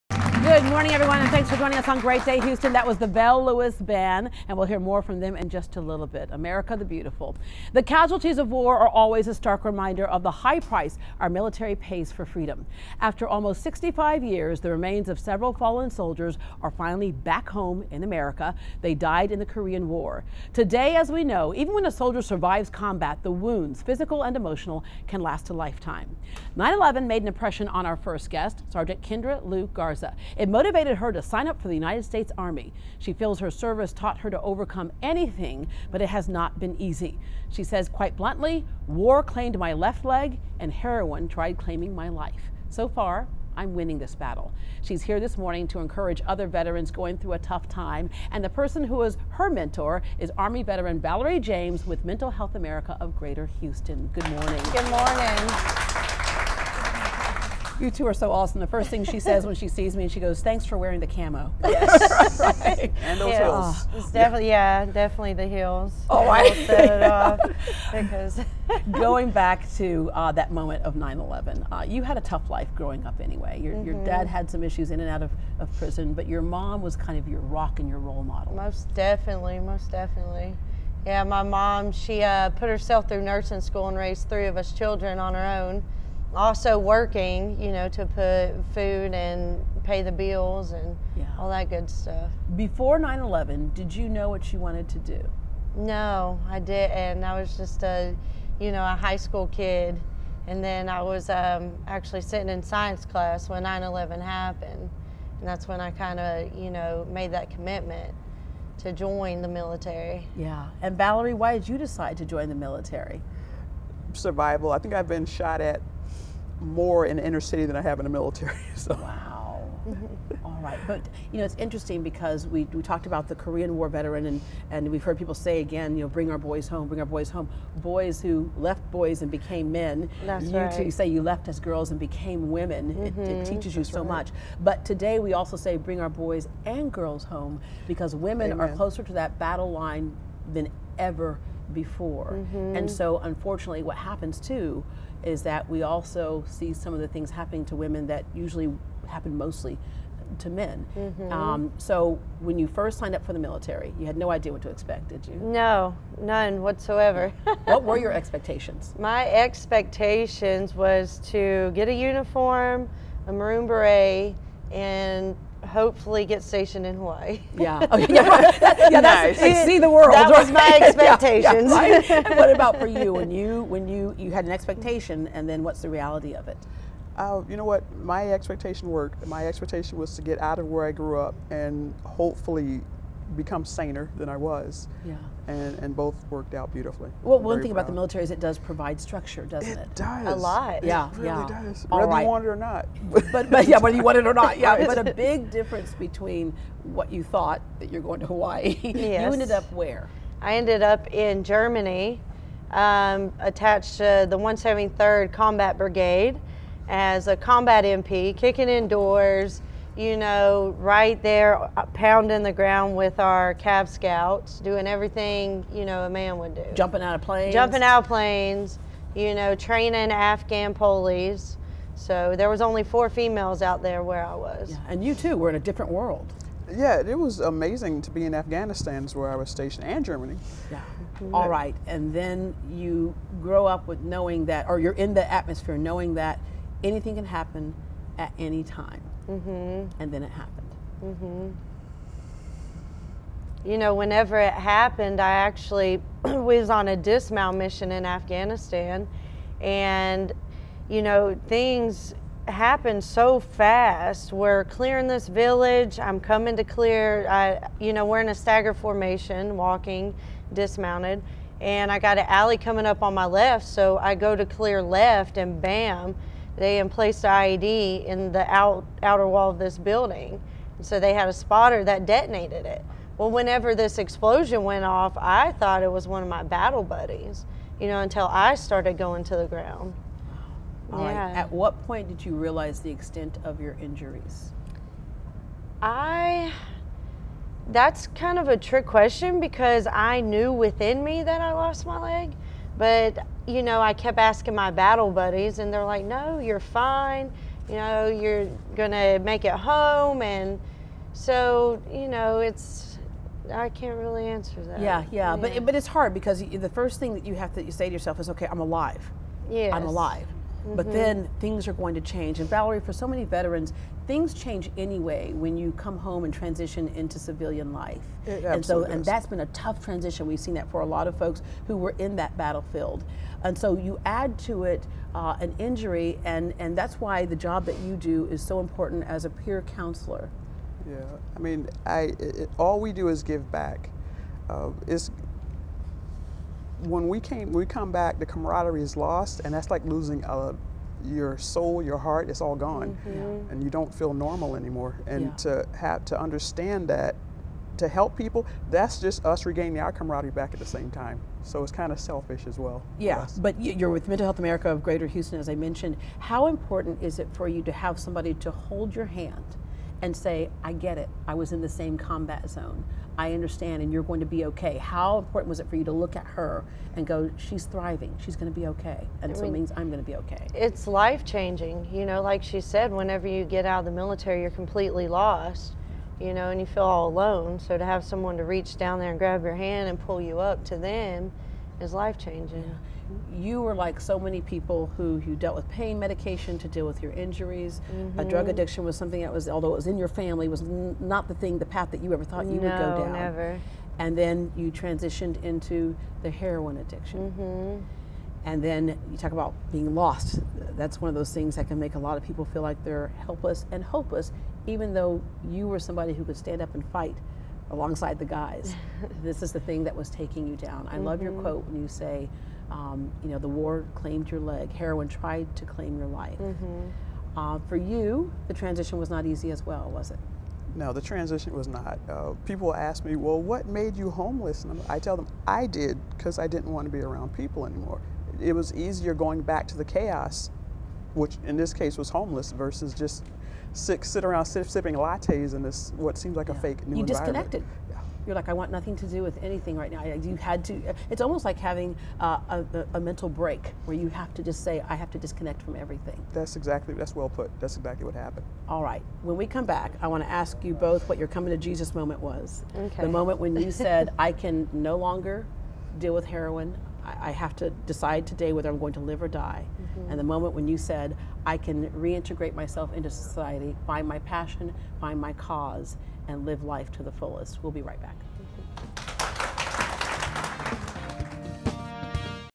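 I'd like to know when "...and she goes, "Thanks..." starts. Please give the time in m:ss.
1:00.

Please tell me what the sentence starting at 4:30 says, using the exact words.
so they had a spotter that detonated it.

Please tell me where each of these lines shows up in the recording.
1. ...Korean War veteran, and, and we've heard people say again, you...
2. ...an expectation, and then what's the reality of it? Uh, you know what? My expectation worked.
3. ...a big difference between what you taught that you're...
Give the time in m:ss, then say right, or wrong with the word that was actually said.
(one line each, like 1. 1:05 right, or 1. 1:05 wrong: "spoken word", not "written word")
1. 2:03 right
2. 2:54 right
3. 3:14 wrong: "thought", not "taught".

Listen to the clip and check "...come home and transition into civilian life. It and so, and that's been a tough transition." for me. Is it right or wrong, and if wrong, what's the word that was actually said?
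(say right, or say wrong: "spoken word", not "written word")
right.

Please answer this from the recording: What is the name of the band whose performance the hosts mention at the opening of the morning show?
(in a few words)
Bell Lewis Band.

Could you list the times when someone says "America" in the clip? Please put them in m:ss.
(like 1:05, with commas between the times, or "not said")
0:06, 0:18, 0:52, 5:54.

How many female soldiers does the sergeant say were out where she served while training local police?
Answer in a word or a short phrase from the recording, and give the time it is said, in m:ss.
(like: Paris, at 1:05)
4, at 3:42.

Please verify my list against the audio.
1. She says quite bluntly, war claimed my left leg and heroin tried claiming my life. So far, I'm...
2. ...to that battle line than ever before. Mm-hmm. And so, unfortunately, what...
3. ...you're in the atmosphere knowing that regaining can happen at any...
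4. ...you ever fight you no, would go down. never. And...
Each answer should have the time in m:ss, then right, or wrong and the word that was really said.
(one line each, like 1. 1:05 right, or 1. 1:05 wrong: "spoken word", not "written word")
1. 0:37 right
2. 2:19 right
3. 3:54 wrong: "anything", not "regaining"
4. 6:32 wrong: "thought", not "fight".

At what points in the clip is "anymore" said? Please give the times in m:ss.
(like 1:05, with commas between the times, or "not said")
5:44, 7:07.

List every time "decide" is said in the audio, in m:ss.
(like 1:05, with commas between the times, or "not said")
1:51, 7:37.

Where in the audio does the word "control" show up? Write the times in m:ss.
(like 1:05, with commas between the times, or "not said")
not said.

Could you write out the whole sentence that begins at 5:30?
Yeah, I mean, I, it, all we do is give back.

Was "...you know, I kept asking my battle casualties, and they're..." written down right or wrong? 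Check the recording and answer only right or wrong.
wrong.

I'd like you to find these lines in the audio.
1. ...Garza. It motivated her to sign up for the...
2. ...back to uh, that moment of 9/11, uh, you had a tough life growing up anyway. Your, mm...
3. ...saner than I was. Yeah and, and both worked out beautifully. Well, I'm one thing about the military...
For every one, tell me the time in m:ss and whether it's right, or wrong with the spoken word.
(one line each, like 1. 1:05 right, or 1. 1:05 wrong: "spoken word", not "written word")
1. 0:29 right
2. 1:09 right
3. 3:03 right.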